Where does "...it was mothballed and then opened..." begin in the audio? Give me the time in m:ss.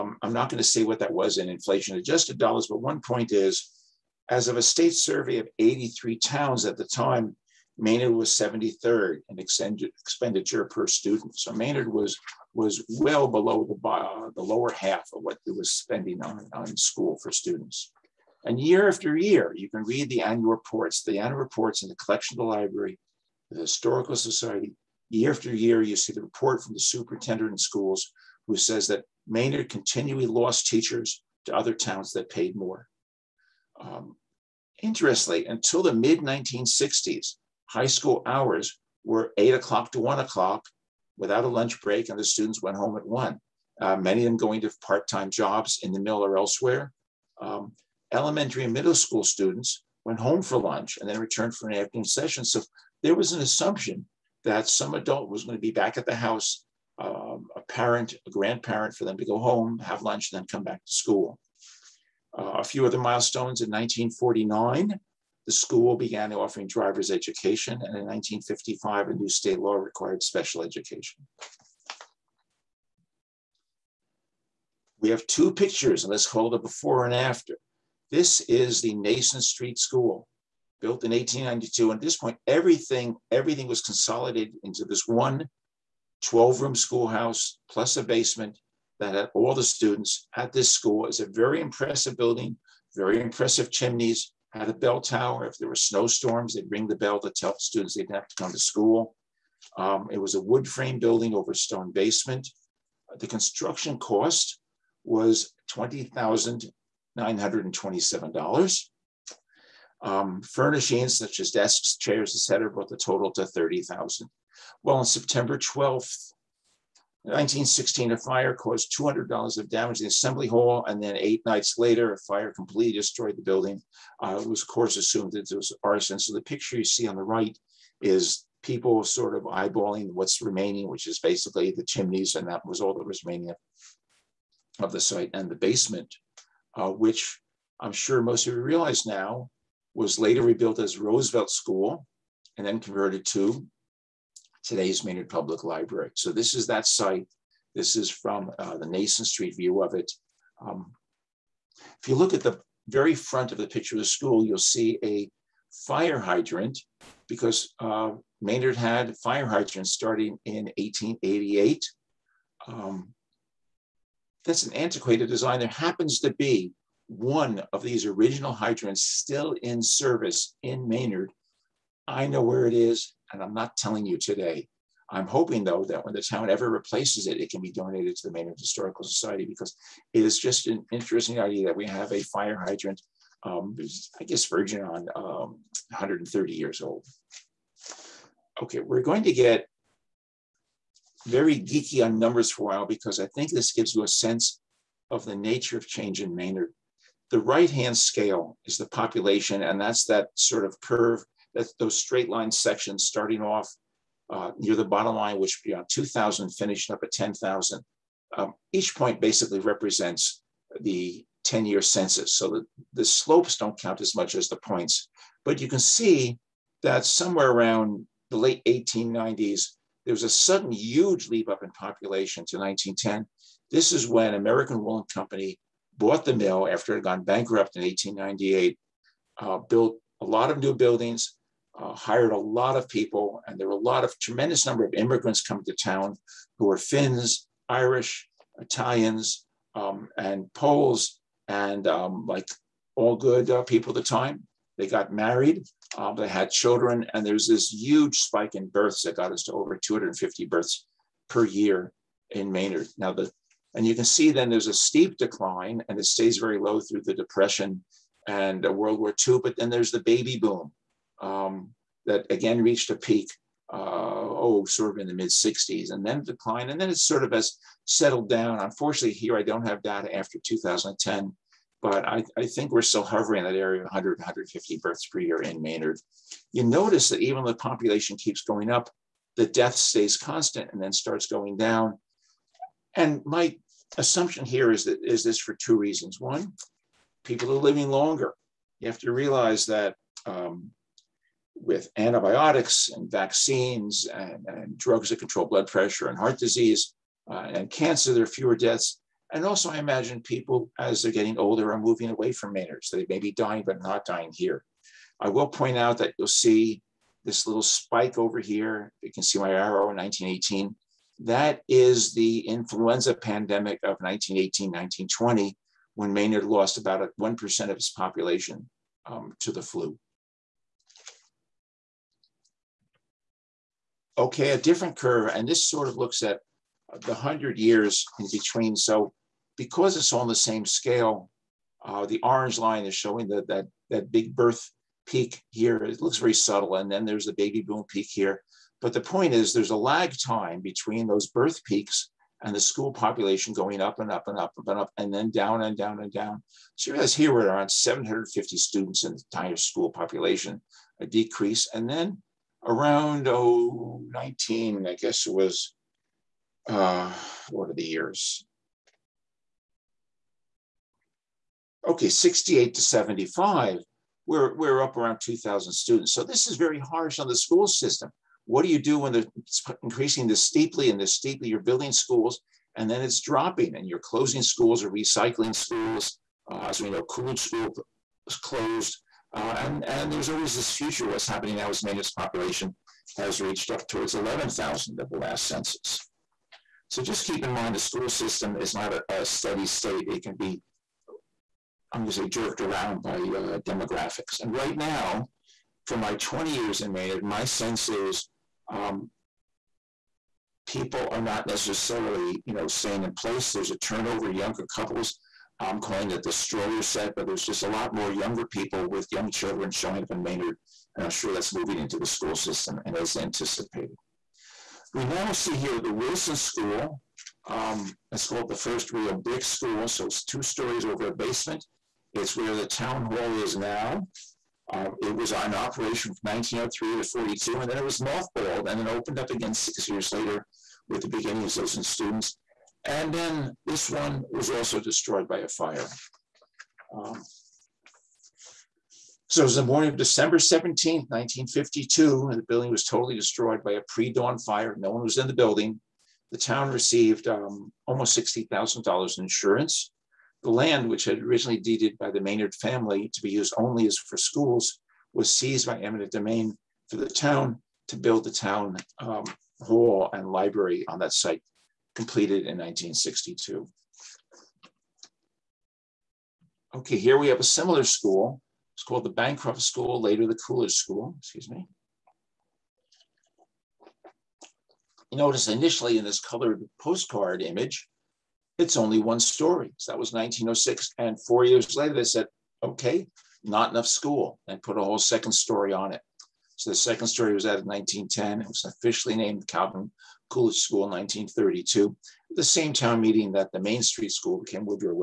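7:07.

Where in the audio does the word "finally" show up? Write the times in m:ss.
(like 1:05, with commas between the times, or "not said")
not said.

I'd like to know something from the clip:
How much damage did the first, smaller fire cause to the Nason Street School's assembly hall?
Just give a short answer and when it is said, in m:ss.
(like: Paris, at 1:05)
$200, at 1:58.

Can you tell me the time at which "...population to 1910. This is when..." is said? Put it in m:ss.
3:41.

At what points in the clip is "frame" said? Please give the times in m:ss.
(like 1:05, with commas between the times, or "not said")
1:40.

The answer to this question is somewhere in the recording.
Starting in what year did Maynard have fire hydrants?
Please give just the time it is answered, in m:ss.
2:40.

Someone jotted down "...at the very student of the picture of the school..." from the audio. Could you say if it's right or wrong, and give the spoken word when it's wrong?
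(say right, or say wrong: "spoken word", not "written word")
wrong: "front", not "student".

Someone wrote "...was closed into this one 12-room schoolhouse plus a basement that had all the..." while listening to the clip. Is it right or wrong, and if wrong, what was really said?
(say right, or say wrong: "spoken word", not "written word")
wrong: "consolidated", not "closed".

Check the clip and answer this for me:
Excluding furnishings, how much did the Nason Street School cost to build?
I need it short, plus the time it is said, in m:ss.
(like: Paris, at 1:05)
$20,927, at 1:45.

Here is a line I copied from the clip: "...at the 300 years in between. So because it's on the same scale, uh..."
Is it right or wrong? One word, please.
wrong.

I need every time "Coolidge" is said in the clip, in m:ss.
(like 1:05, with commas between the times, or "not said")
6:17, 7:50, 8:10.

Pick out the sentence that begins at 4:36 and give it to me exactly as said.
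You notice that even though the population keeps going up, the death stays constant and then starts going down.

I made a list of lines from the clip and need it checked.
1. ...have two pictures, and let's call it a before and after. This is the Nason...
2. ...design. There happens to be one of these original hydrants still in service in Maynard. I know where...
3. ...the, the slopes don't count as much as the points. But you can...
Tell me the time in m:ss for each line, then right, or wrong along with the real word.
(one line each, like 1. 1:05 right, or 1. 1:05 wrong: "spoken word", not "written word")
1. 1:15 right
2. 2:45 right
3. 3:32 right.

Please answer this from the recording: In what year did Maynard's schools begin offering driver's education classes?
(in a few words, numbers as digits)
1949.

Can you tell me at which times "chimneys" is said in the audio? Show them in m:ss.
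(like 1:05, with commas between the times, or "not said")
1:33, 2:11.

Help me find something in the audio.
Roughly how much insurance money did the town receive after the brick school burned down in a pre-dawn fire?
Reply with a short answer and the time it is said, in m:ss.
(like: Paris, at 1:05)
$60,000, at 7:28.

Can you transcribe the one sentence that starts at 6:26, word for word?
So just keep in mind the school system is not a, a steady state.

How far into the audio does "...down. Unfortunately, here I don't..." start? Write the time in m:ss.
4:28.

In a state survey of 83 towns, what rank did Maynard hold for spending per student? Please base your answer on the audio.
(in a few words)
73rd.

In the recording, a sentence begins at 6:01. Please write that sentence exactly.
Okay, 68 to 75, we're, we're up around 2,000 students.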